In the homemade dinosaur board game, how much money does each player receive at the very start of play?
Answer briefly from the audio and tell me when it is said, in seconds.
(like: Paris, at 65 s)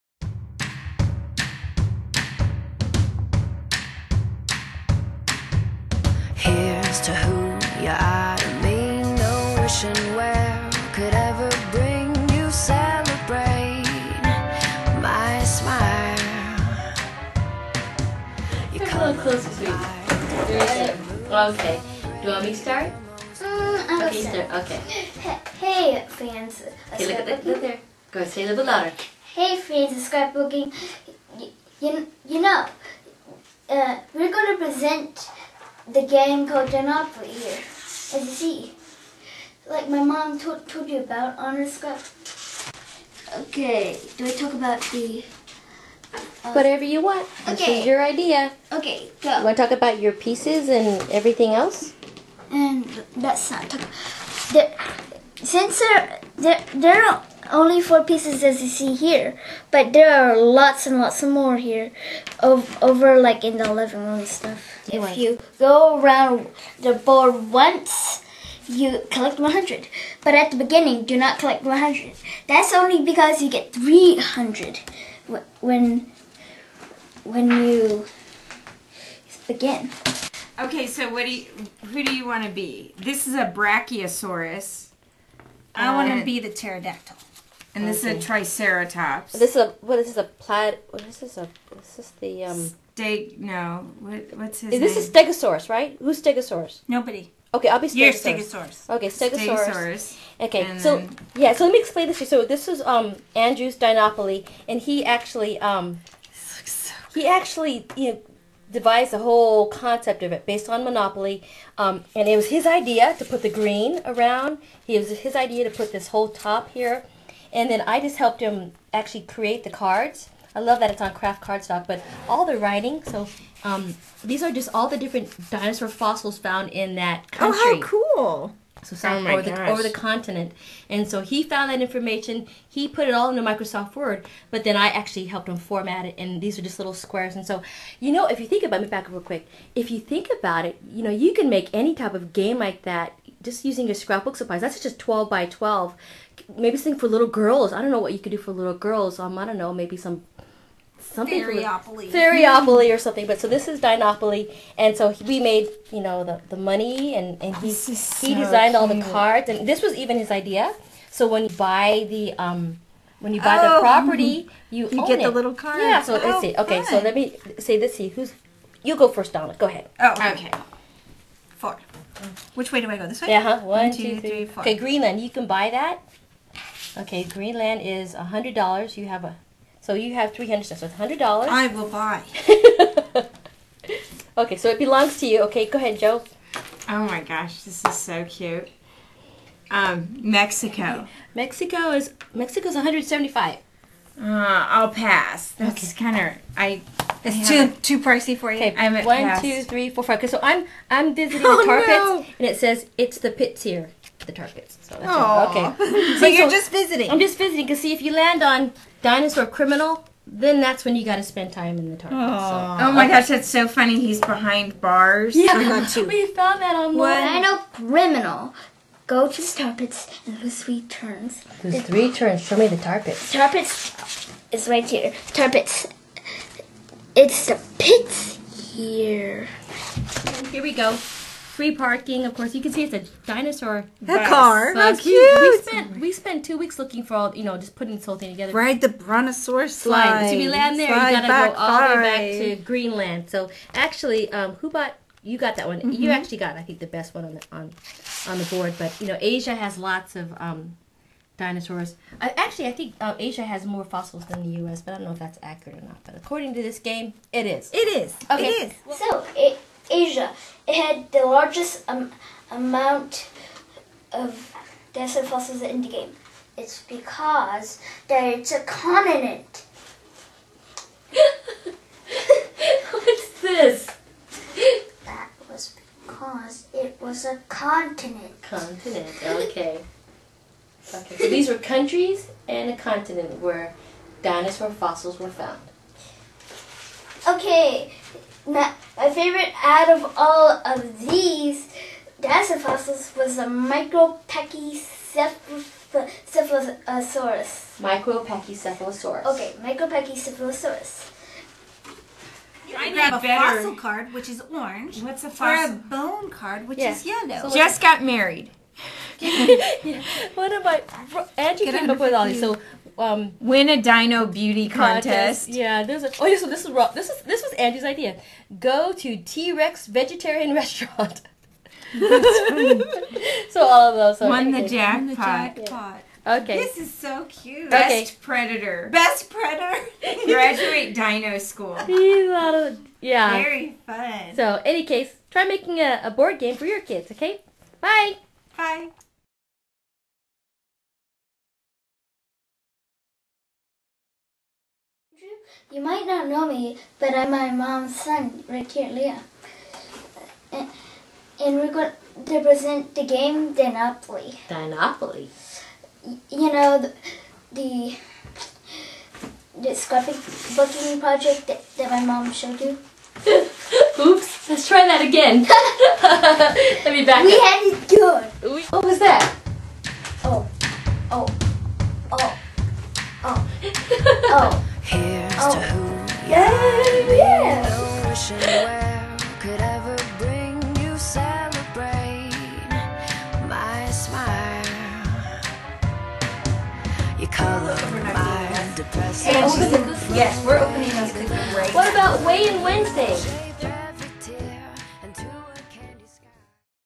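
300, at 73 s.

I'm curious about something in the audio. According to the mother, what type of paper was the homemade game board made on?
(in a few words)
Kraft Cardstock.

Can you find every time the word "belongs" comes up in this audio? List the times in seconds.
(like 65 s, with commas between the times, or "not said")
184 s.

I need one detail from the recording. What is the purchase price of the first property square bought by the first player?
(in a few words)
$100.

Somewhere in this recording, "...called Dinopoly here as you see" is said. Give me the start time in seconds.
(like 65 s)
36 s.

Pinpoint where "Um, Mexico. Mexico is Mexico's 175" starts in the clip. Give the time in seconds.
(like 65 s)
189 s.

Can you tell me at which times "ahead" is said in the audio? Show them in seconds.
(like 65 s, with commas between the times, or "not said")
169 s, 185 s.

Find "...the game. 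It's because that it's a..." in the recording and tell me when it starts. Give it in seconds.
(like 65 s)
265 s.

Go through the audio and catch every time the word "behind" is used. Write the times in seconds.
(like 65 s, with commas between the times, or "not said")
214 s.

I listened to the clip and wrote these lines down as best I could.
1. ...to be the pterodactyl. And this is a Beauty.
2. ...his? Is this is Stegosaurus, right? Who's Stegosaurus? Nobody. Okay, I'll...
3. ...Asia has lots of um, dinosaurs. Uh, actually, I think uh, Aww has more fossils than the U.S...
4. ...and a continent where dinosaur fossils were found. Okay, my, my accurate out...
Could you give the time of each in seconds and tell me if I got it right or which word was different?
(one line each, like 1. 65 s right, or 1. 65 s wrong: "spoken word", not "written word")
1. 86 s wrong: "Triceratops", not "Beauty"
2. 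94 s right
3. 249 s wrong: "Asia", not "Aww"
4. 282 s wrong: "favorite", not "accurate".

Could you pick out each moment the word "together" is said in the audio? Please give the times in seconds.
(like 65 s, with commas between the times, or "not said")
238 s.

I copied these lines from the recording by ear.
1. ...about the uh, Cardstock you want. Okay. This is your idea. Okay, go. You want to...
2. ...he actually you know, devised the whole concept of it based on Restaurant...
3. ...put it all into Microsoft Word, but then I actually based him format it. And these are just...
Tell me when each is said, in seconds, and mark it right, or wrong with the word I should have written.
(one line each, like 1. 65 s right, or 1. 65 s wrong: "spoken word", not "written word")
1. 44 s wrong: "Whatever", not "Cardstock"
2. 107 s wrong: "Monopoly", not "Restaurant"
3. 132 s wrong: "helped", not "based".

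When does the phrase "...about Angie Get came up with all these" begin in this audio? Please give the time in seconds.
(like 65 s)
310 s.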